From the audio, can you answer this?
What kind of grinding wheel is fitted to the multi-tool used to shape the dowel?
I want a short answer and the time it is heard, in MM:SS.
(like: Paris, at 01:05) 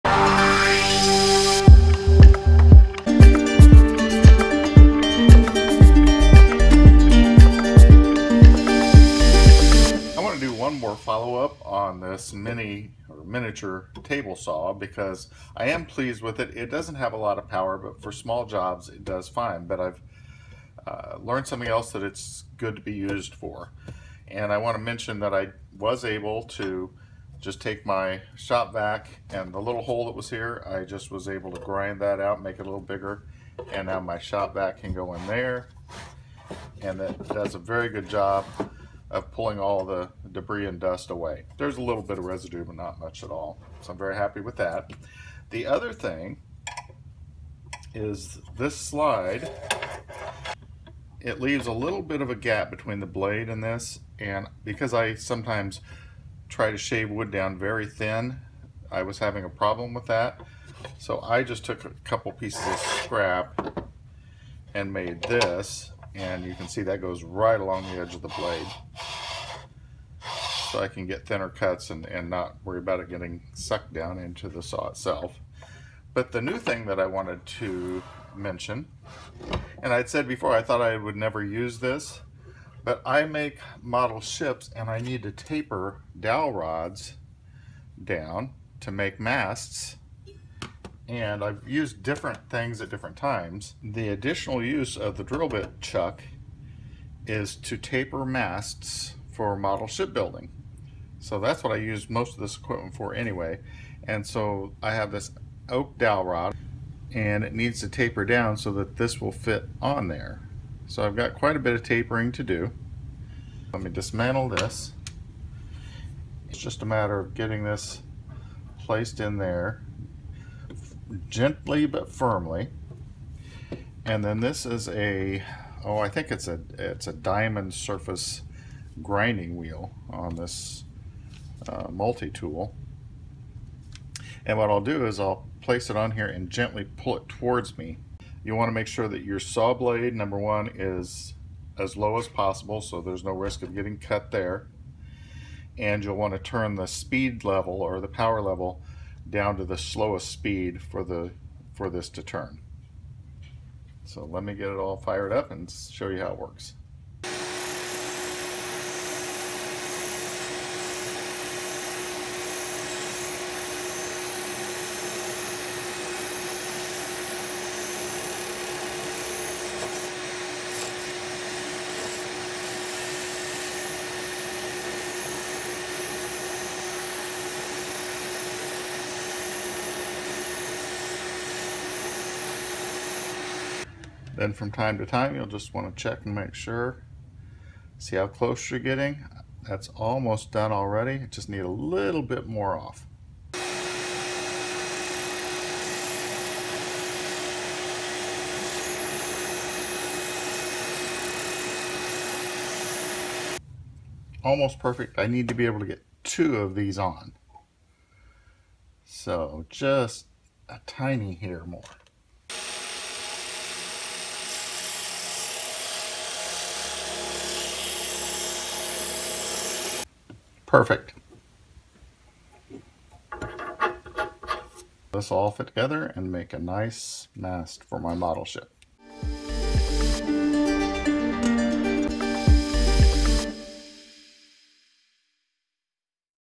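Diamond surface grinding wheel, at 02:07.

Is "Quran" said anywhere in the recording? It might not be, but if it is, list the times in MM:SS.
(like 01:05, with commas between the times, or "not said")
not said.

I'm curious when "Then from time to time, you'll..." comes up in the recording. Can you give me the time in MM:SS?
03:04.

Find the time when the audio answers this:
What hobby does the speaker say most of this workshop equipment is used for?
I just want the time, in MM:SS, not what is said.
01:39.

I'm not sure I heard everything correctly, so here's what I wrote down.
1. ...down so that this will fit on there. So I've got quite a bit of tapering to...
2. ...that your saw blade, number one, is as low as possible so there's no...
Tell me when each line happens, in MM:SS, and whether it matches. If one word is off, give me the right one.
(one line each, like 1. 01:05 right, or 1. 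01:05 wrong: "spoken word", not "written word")
1. 01:48 right
2. 02:19 right.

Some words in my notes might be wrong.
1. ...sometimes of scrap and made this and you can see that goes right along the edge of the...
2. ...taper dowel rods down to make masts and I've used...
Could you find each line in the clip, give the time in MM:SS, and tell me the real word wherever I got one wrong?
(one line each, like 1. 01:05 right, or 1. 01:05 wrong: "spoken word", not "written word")
1. 01:02 wrong: "pieces", not "sometimes"
2. 01:25 right.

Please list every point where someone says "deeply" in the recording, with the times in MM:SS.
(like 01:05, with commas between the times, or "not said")
not said.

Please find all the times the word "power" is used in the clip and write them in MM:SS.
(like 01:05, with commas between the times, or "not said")
00:17, 02:28.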